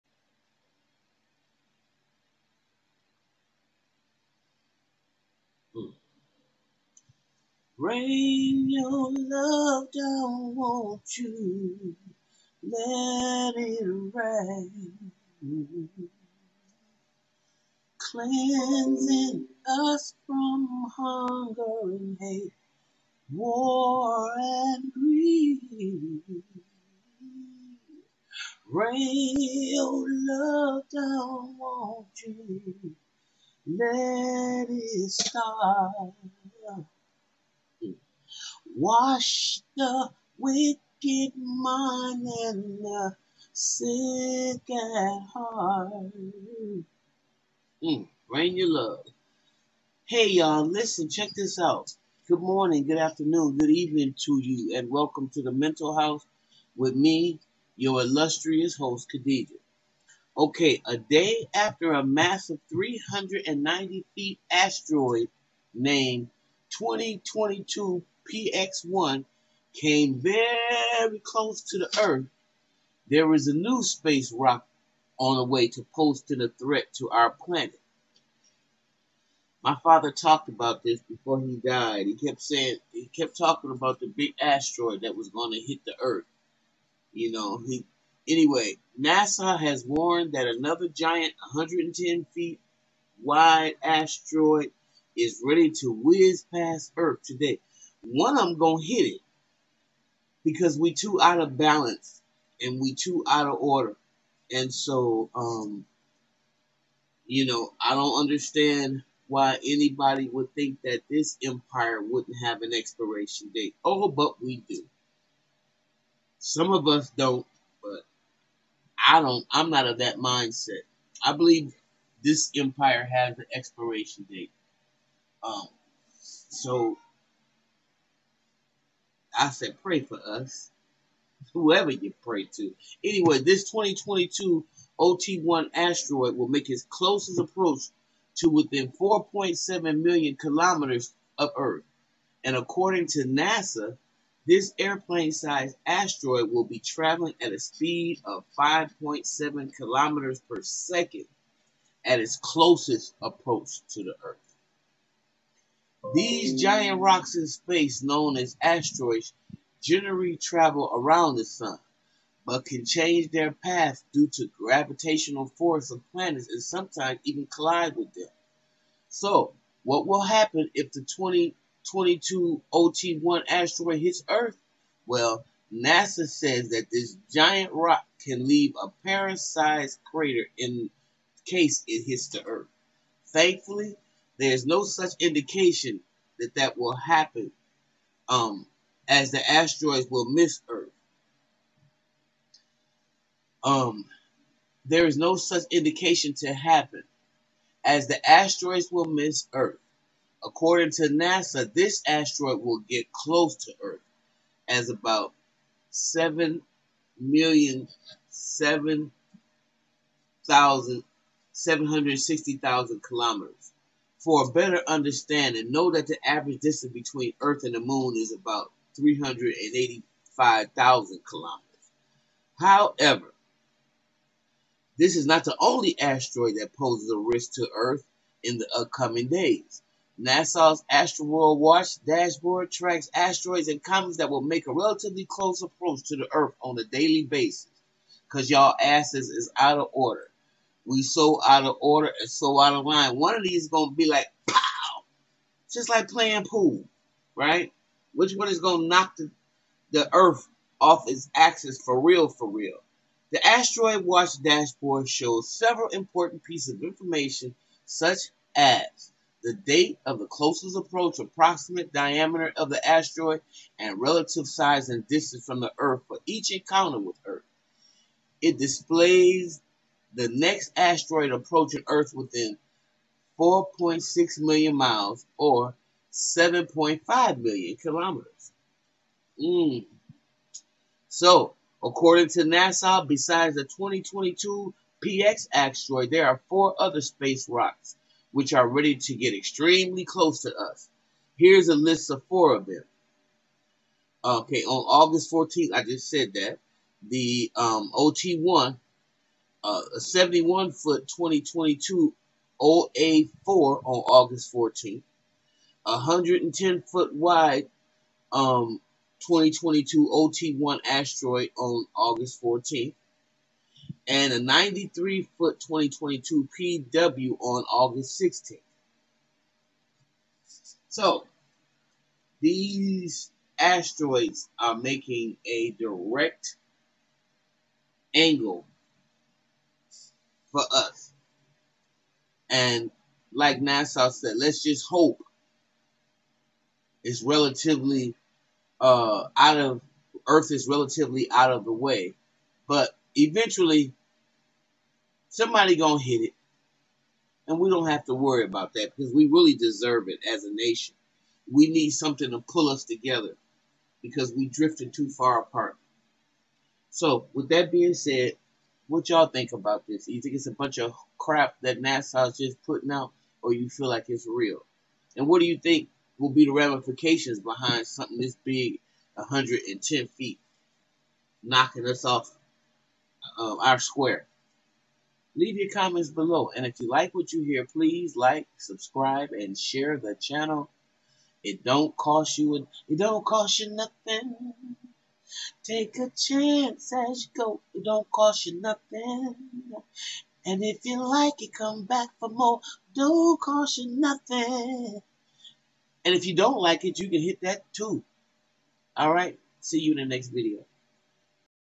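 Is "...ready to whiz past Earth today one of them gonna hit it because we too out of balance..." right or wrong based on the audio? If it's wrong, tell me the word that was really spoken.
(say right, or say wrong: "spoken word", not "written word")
right.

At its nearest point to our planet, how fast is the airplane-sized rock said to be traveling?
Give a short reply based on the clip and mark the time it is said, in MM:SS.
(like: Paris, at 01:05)
5.7 kilometers per second, at 02:28.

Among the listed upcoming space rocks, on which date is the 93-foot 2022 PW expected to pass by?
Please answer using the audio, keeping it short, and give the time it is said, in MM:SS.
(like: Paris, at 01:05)
August 16th, at 05:17.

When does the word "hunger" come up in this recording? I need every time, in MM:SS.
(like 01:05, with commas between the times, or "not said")
00:20.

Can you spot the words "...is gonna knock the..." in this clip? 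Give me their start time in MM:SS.
04:08.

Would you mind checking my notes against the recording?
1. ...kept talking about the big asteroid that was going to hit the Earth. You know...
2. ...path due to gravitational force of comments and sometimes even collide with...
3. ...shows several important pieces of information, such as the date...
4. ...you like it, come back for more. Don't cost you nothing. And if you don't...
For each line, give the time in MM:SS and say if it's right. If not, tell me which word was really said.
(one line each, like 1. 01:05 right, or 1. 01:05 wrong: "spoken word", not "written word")
1. 01:23 right
2. 02:43 wrong: "planets", not "comments"
3. 04:15 right
4. 06:30 right.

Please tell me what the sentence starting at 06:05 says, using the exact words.
And what do you think will be the ramifications behind something this big, 110 feet, knocking us off um, our square?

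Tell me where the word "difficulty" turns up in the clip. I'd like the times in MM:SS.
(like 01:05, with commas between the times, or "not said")
not said.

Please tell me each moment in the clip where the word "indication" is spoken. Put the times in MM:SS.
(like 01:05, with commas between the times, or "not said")
03:05, 03:15.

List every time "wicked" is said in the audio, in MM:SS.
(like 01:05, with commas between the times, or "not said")
00:40.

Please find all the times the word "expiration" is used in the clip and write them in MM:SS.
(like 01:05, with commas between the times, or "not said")
01:52, 02:03.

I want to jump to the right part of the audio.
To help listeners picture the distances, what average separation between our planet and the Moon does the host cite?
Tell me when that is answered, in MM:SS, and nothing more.
03:38.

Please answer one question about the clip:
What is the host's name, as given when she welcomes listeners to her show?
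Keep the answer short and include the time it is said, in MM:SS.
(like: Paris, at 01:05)
Khadijah, at 00:59.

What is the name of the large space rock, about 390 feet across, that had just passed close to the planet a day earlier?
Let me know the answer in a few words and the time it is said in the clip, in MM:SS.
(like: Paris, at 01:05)
2022 PX1, at 01:06.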